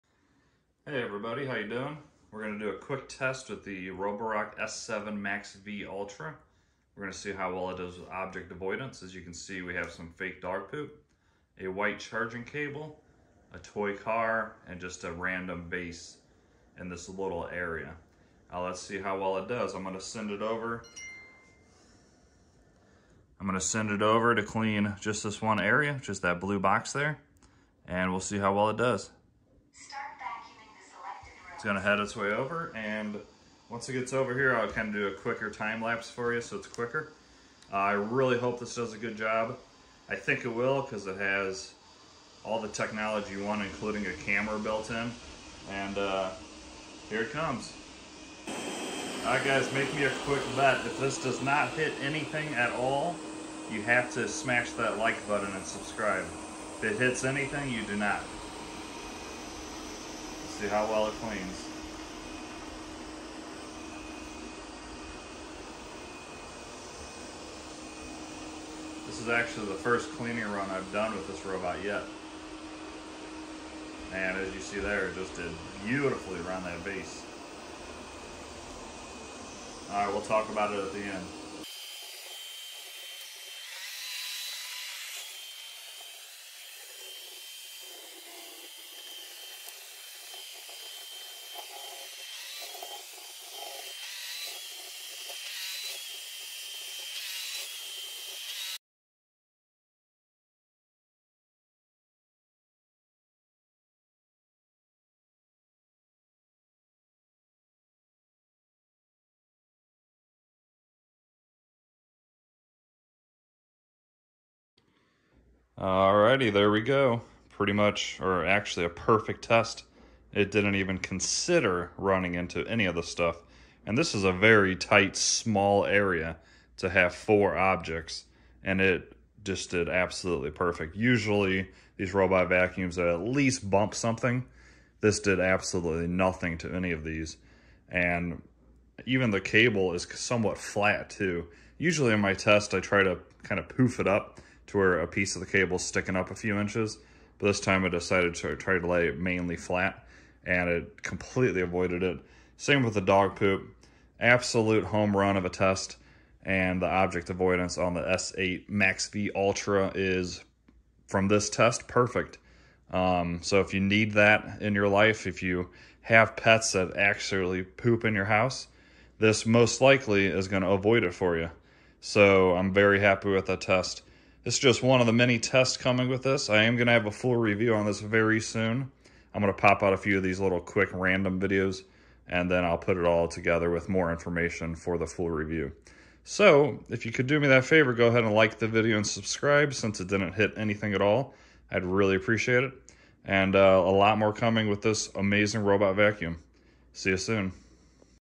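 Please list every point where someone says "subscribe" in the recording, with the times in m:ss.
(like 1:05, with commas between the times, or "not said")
0:55, 3:09.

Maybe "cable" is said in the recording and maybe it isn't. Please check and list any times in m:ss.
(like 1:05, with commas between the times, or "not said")
0:12, 2:19, 2:25.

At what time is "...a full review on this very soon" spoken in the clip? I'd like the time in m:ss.
2:57.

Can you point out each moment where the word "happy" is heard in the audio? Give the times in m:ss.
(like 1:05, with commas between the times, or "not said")
2:52.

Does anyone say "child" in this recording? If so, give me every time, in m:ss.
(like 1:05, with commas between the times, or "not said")
not said.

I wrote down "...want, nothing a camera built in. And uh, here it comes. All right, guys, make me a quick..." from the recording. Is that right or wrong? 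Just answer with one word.
wrong.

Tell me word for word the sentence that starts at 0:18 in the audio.
Now let's see how well it does.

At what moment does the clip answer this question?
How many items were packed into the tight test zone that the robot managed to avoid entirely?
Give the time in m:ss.
2:07.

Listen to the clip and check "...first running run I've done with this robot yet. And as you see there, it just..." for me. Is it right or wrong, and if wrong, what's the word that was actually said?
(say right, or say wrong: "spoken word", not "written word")
wrong: "cleaning", not "running".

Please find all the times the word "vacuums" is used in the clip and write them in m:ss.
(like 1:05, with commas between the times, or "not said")
2:12, 3:15.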